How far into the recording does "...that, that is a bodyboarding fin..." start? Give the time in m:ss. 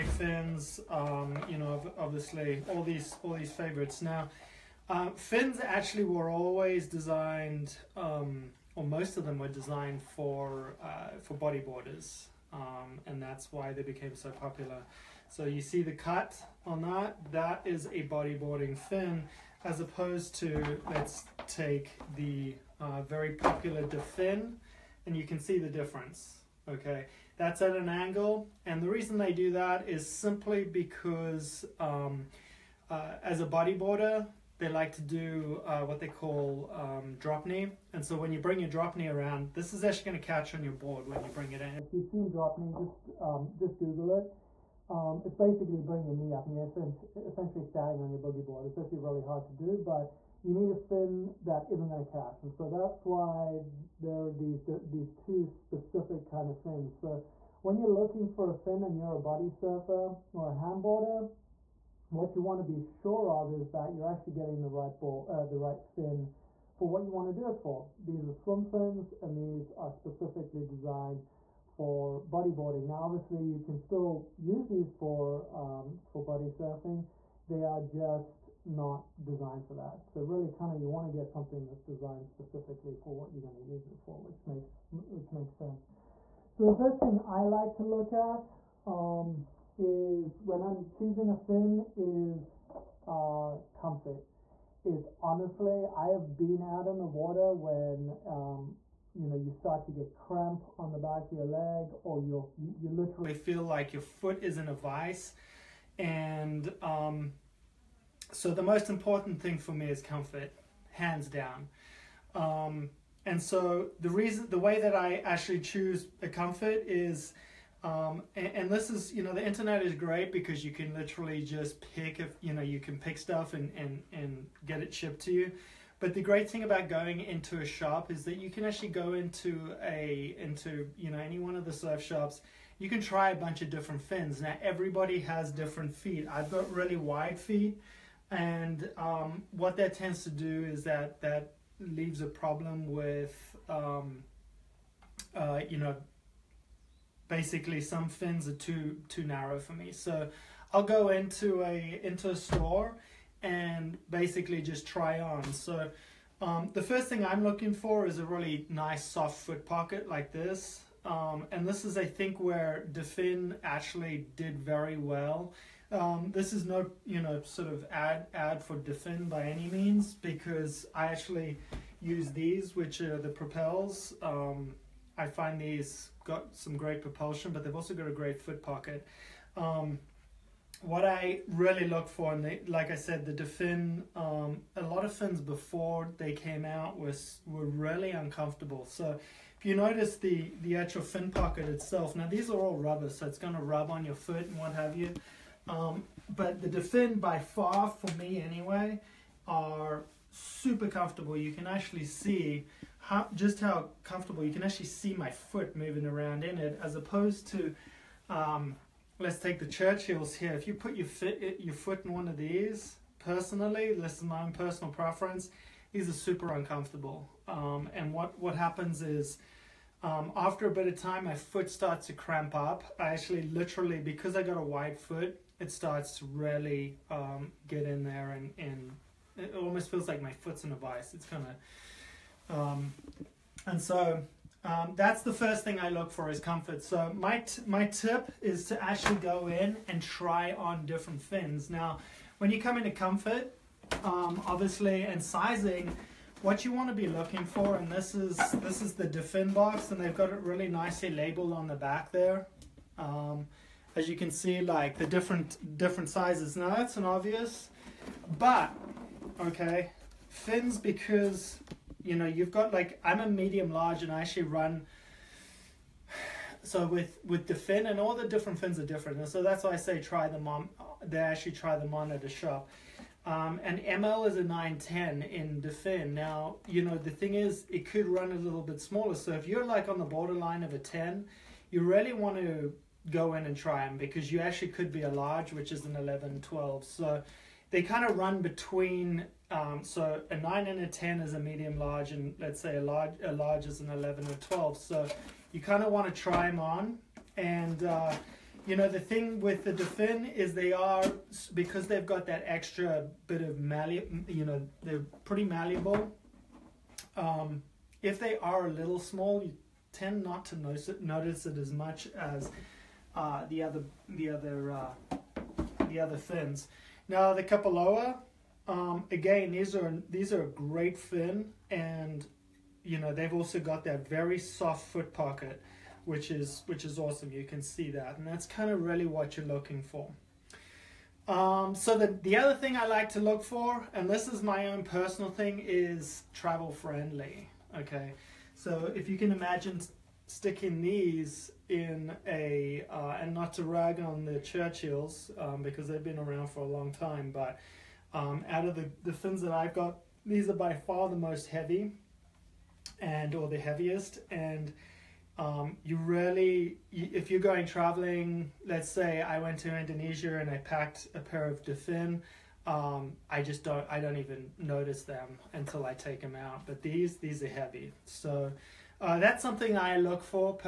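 0:16.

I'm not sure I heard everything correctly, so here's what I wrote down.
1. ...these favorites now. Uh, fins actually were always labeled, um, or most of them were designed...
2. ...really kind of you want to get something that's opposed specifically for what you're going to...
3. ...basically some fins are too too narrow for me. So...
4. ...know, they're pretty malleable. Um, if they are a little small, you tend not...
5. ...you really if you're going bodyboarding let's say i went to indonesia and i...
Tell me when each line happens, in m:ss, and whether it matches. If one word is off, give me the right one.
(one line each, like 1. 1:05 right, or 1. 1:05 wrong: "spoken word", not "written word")
1. 0:03 wrong: "designed", not "labeled"
2. 1:20 wrong: "designed", not "opposed"
3. 2:27 right
4. 5:04 right
5. 5:55 wrong: "traveling", not "bodyboarding".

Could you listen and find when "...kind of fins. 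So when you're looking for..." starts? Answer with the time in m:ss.
0:56.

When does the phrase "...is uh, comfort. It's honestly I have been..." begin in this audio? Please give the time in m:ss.
1:31.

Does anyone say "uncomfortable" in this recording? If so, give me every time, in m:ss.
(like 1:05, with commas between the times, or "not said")
3:08, 3:36.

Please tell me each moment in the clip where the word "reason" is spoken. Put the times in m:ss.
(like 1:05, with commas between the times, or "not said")
0:28, 1:54.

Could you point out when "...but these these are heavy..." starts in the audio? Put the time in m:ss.
6:06.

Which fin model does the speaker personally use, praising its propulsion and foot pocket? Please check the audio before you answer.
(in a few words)
Propels.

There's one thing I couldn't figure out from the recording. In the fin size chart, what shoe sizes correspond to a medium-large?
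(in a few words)
9 to 10.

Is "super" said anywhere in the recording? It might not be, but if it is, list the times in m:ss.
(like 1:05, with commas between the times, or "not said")
3:20, 3:36.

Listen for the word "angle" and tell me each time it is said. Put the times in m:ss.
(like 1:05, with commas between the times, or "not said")
0:27.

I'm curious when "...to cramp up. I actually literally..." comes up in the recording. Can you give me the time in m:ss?
3:42.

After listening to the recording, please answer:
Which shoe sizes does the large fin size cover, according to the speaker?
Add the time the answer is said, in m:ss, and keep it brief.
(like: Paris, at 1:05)
11 to 12, at 4:45.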